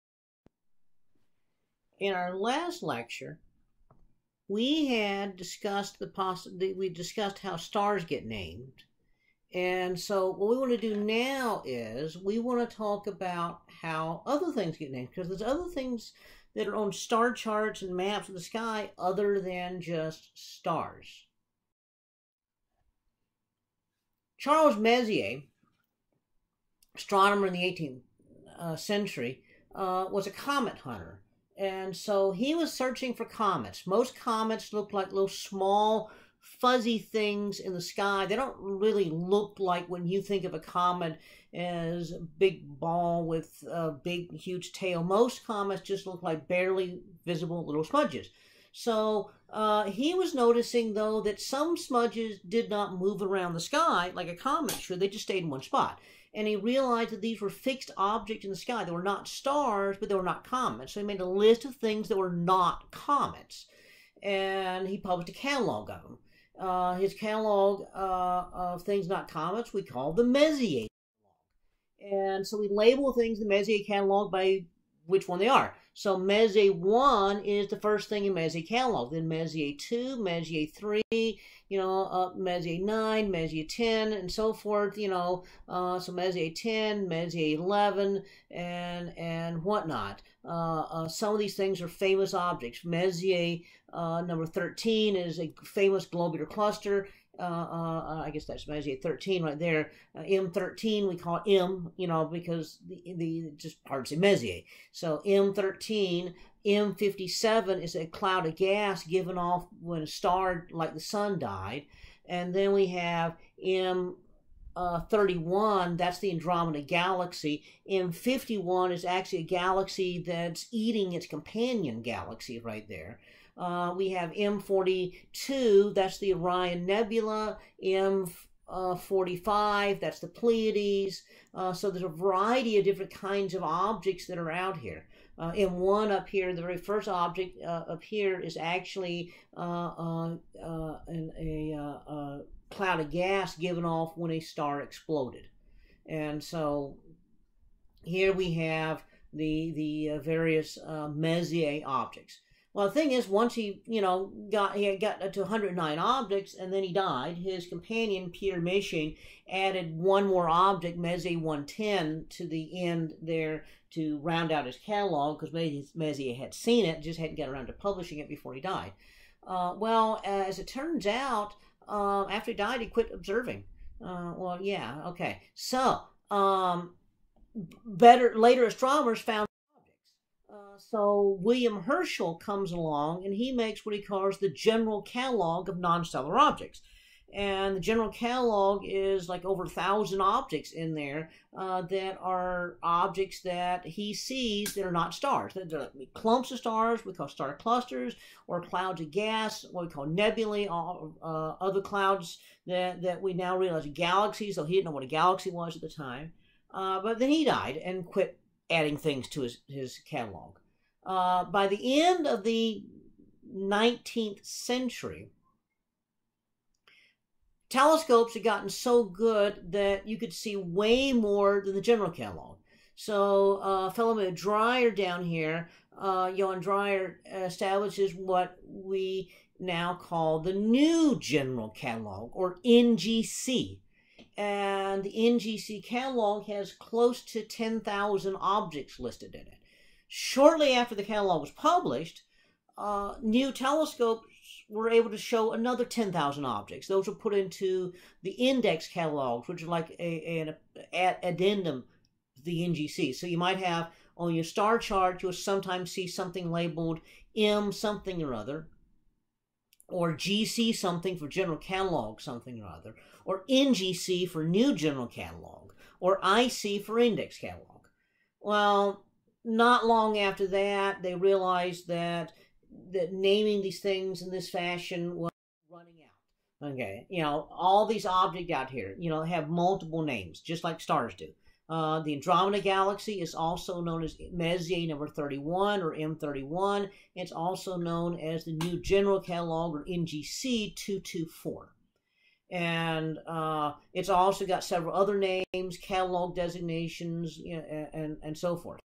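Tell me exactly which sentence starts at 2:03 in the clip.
Uh, we have M42, that's the Orion Nebula.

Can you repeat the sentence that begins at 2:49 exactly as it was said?
Uh, well, as it turns out, um, after he died, he quit observing.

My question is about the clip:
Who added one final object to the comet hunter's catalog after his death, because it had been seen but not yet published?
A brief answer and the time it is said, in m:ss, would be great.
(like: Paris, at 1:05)
Pierre Méchain, at 2:38.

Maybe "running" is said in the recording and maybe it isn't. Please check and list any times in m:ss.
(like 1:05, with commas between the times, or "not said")
4:35.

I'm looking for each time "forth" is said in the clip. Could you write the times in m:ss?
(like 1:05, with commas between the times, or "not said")
1:24, 4:58.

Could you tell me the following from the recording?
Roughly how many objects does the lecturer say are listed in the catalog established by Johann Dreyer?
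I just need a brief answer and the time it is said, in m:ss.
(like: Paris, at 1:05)
10,000, at 3:56.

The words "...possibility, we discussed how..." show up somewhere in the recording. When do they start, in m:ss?
0:06.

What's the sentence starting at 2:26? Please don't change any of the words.
And so here we have the the uh, various uh, Messier objects.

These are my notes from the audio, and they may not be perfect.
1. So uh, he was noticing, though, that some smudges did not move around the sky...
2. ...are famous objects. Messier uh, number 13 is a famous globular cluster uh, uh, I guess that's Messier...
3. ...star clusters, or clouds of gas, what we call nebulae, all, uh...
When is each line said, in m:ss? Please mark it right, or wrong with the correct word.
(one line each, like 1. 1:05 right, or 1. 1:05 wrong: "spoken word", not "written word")
1. 0:48 right
2. 1:31 right
3. 3:17 right.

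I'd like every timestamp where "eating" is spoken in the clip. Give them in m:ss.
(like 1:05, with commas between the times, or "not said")
2:00.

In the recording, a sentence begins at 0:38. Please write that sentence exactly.
They don't really look like when you think of a comet as a big ball with a big, huge tail.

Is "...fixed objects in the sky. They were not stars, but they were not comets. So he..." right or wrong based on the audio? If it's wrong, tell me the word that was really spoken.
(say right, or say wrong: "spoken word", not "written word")
right.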